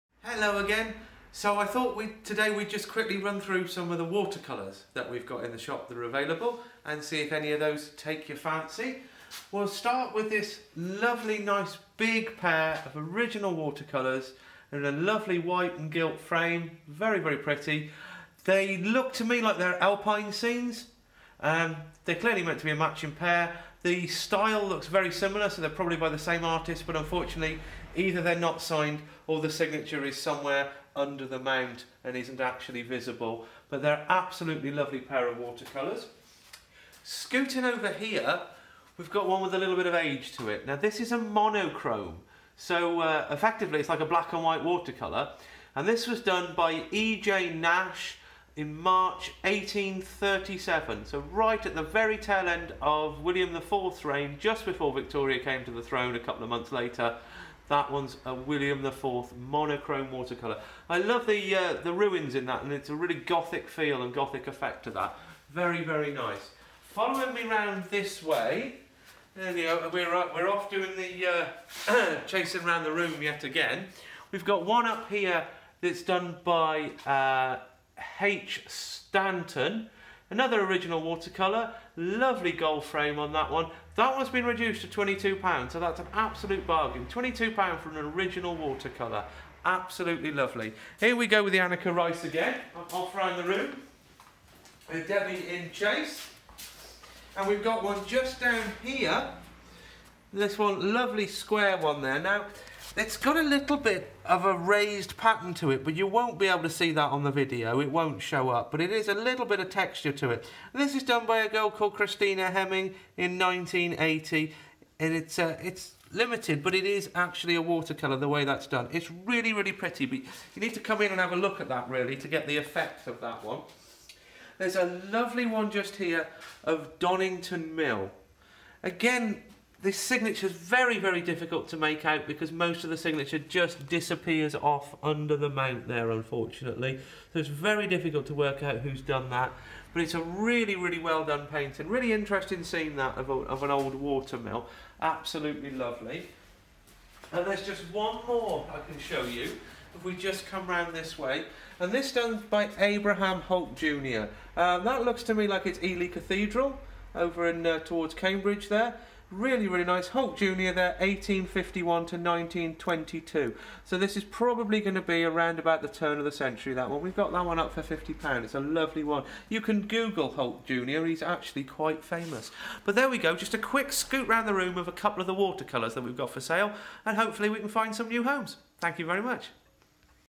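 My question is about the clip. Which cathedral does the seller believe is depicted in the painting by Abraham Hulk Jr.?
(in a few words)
Ely Cathedral.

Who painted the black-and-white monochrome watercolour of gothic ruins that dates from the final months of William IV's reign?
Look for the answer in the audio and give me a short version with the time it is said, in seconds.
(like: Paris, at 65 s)
E.J. Nash, at 46 s.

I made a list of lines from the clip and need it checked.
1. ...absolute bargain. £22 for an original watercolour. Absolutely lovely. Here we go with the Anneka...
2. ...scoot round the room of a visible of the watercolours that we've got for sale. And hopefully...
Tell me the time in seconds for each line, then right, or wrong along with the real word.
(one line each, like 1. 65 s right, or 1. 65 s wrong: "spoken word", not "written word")
1. 86 s right
2. 173 s wrong: "couple", not "visible".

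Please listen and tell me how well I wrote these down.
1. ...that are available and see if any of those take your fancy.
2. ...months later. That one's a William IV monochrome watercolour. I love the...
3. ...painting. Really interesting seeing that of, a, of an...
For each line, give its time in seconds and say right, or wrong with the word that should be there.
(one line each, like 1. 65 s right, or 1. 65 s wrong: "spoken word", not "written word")
1. 5 s right
2. 56 s right
3. 141 s right.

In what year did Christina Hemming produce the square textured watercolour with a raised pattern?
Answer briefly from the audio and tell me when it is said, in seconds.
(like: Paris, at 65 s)
1980, at 113 s.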